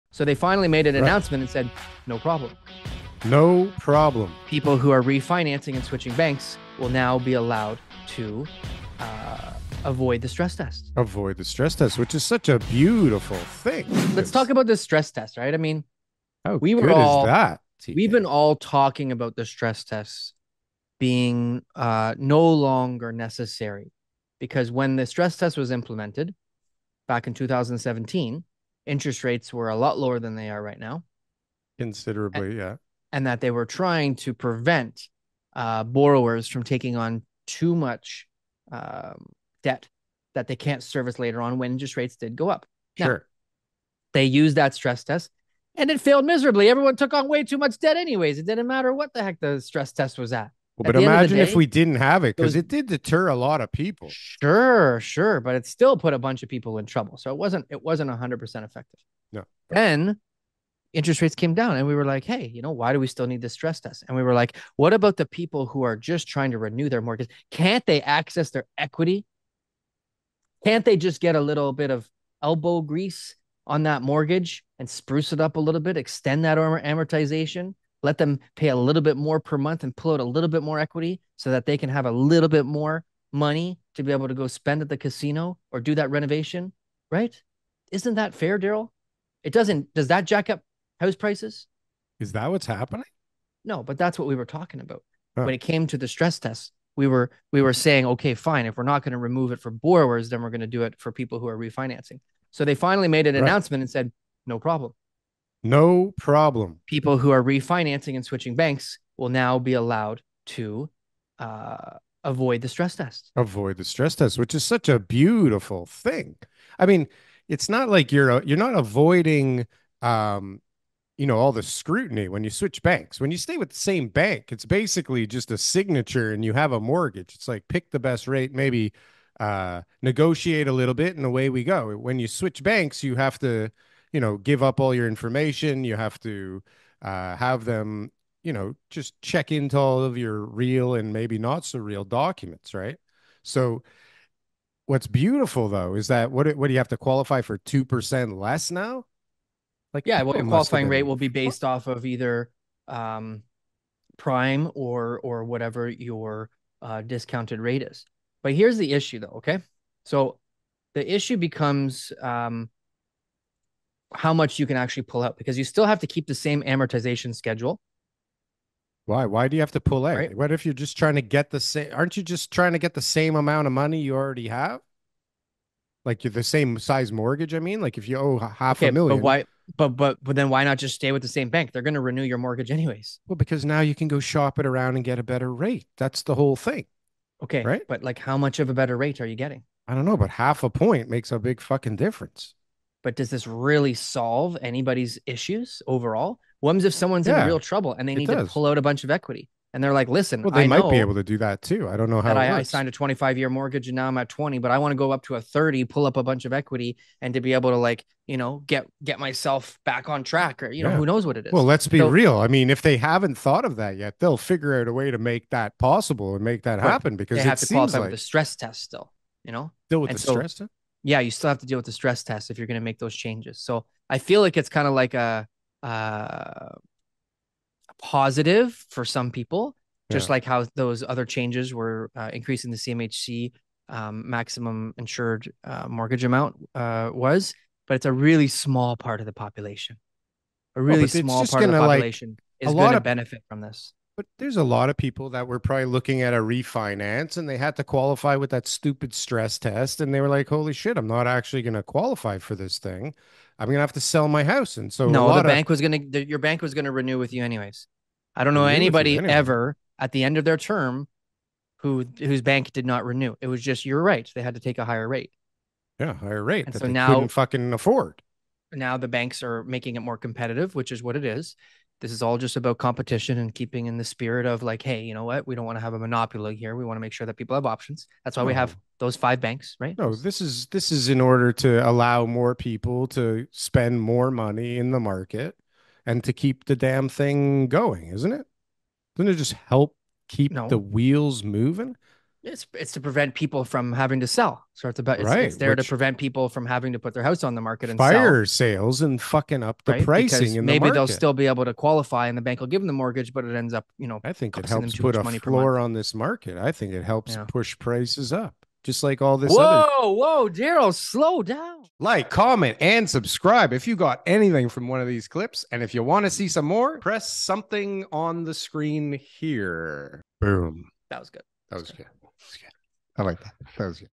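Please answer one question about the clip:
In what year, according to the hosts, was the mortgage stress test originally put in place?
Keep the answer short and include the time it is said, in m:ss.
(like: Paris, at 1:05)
2017, at 0:27.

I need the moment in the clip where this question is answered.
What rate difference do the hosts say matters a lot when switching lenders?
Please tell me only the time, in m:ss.
3:10.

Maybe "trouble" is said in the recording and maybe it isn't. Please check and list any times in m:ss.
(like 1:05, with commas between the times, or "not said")
0:56, 3:17.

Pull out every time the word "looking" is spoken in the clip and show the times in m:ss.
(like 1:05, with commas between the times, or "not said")
4:05.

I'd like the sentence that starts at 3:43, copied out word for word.
So I feel like it's kind of like a, uh, a, positive for some people, just yeah.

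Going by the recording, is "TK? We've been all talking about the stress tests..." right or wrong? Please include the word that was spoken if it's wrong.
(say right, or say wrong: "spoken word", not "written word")
right.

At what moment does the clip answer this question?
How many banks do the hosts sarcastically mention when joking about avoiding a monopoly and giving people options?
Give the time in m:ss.
4:39.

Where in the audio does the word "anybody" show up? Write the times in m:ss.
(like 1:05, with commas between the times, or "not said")
3:14, 4:18.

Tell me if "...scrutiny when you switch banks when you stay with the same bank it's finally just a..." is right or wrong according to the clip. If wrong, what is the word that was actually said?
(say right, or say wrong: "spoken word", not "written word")
wrong: "basically", not "finally".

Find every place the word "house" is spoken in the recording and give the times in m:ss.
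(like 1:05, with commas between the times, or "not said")
1:30, 4:14, 4:57.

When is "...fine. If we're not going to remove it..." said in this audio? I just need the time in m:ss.
1:38.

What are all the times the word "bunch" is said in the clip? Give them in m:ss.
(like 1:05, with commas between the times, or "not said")
0:56, 3:18, 3:26.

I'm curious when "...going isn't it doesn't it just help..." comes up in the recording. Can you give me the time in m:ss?
4:47.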